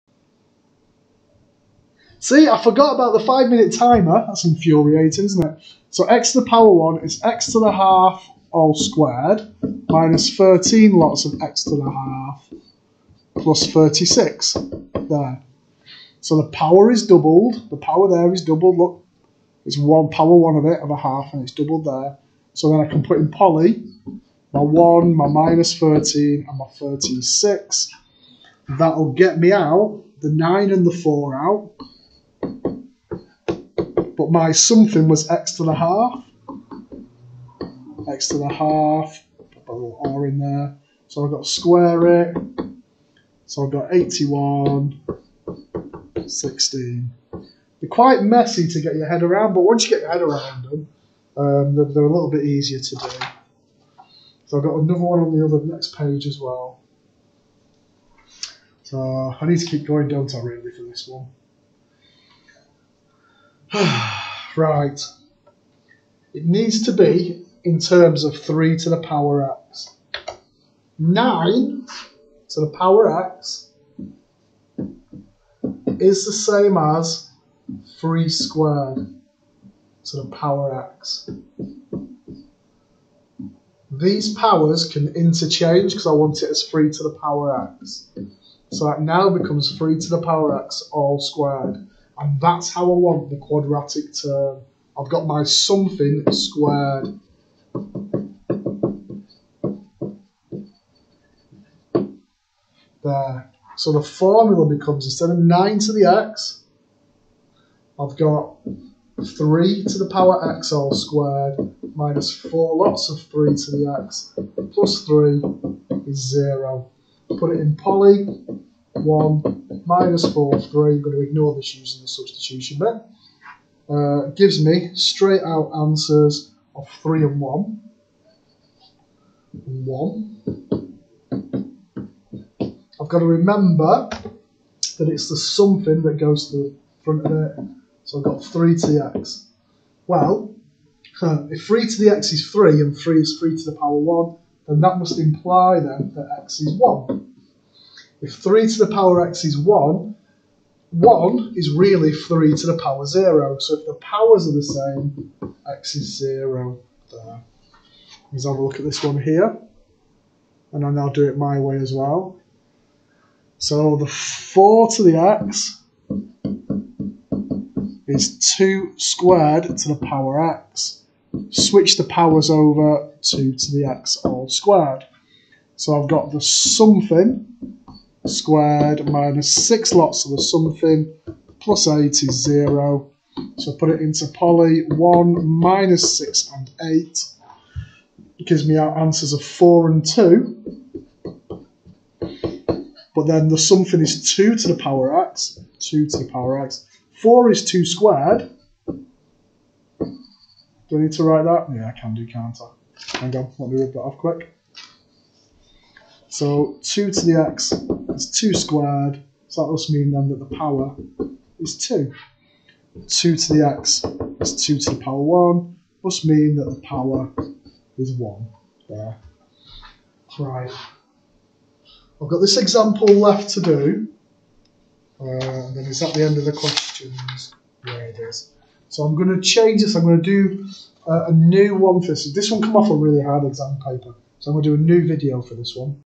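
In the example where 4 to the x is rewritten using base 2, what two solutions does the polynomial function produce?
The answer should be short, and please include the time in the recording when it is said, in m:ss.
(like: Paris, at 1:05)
4 and 2, at 3:09.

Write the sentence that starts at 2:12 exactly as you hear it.
I've got to remember that it's the something that goes to the front of it, so I've got 3tx.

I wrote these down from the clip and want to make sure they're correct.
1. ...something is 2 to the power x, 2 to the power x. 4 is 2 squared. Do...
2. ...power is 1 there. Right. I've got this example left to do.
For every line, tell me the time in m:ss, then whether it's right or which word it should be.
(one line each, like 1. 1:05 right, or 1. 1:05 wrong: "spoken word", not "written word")
1. 3:13 right
2. 3:36 right.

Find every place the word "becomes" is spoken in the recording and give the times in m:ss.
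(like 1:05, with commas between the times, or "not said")
1:29, 1:44.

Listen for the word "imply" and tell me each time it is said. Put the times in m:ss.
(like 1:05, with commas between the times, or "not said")
2:25.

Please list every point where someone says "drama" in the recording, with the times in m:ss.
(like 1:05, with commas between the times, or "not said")
not said.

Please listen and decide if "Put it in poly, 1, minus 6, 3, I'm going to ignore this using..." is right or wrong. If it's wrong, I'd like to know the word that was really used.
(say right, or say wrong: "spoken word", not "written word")
wrong: "4", not "6".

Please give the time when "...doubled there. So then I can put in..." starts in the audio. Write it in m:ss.
0:21.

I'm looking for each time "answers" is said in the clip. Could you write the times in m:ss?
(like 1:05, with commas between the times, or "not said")
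2:05, 3:08.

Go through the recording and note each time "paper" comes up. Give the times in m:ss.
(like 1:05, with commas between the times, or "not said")
3:53.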